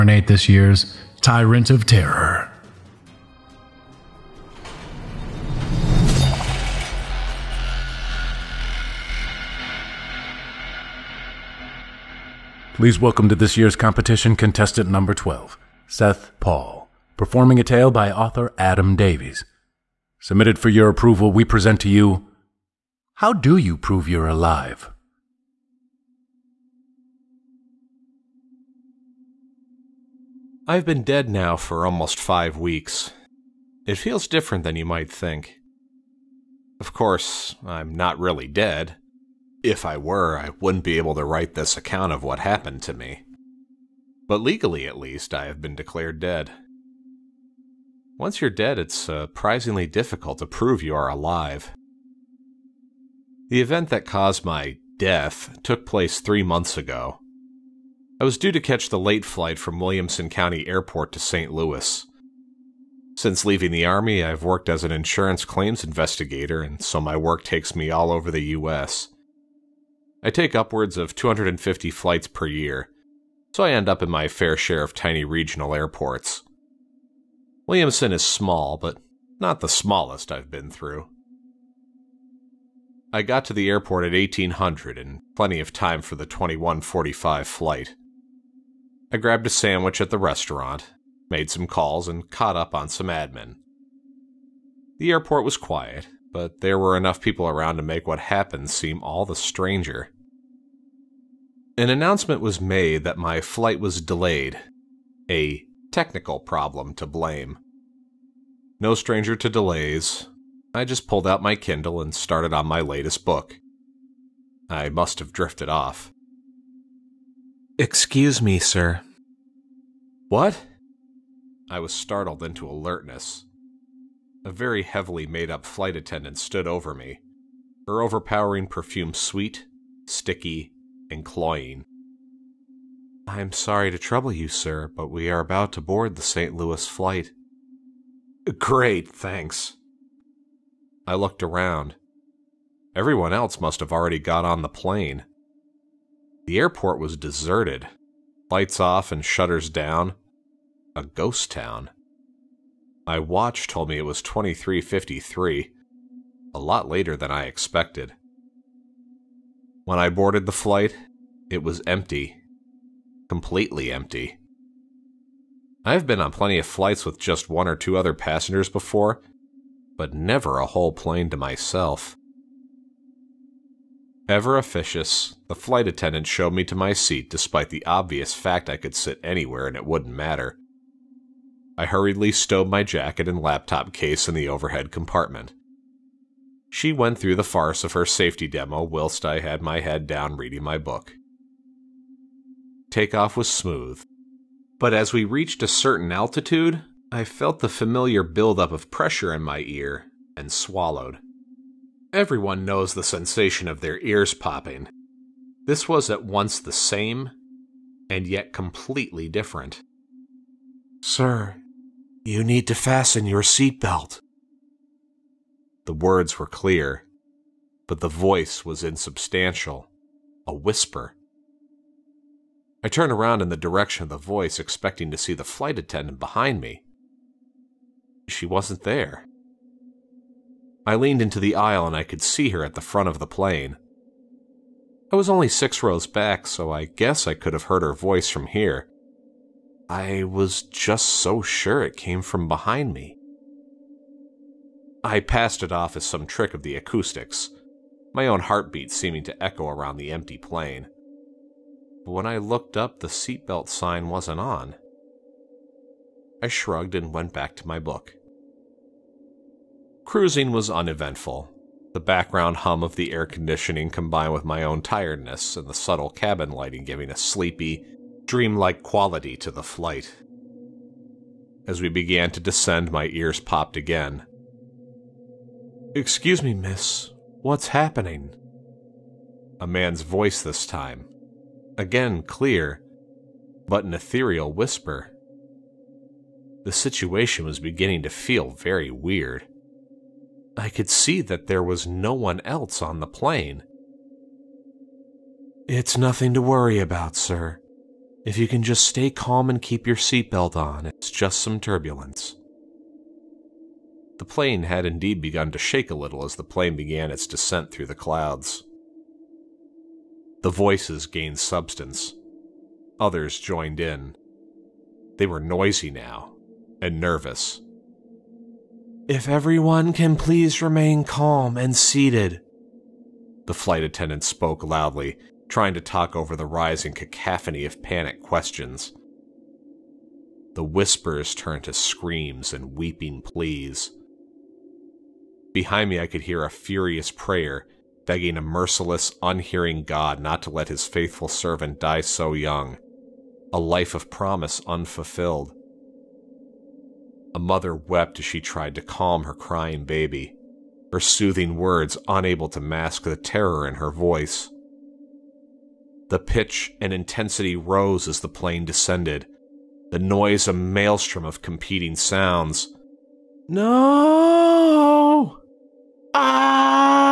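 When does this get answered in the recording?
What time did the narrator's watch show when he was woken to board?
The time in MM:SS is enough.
02:34.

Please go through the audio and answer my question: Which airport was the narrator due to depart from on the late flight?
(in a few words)
Williamson County Airport.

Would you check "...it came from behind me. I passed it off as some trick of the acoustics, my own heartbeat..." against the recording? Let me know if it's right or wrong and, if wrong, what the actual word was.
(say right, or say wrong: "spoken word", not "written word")
right.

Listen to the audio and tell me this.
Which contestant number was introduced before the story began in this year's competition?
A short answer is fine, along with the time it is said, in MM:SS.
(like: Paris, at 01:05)
12, at 00:15.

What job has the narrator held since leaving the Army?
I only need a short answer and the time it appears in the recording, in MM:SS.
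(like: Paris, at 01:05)
insurance claims investigator, at 01:04.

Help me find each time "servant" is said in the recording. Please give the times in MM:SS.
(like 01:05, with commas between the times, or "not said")
05:41.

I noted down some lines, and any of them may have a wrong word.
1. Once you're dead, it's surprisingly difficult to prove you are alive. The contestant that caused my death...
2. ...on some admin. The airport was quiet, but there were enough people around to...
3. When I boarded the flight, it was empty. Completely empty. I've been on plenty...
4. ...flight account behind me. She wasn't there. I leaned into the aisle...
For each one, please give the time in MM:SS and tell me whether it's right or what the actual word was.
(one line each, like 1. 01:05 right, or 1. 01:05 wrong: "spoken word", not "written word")
1. 00:48 wrong: "event", not "contestant"
2. 01:32 right
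3. 02:39 right
4. 03:45 wrong: "attendant", not "account".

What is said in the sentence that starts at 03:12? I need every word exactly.
Takeoff was smooth, but as we reached a certain altitude, I felt the familiar buildup of pressure in my ear and swallowed.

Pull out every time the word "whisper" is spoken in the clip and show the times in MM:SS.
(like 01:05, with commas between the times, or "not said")
03:40, 04:44, 05:30.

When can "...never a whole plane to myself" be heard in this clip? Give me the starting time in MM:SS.
02:50.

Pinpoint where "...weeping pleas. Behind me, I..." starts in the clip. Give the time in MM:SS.
05:32.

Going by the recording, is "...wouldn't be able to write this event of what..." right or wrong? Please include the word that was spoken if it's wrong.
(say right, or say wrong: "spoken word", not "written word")
wrong: "account", not "event".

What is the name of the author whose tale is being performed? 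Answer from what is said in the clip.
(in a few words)
Adam Davies.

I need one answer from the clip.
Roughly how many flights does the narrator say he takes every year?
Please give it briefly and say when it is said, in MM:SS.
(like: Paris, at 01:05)
250, at 01:11.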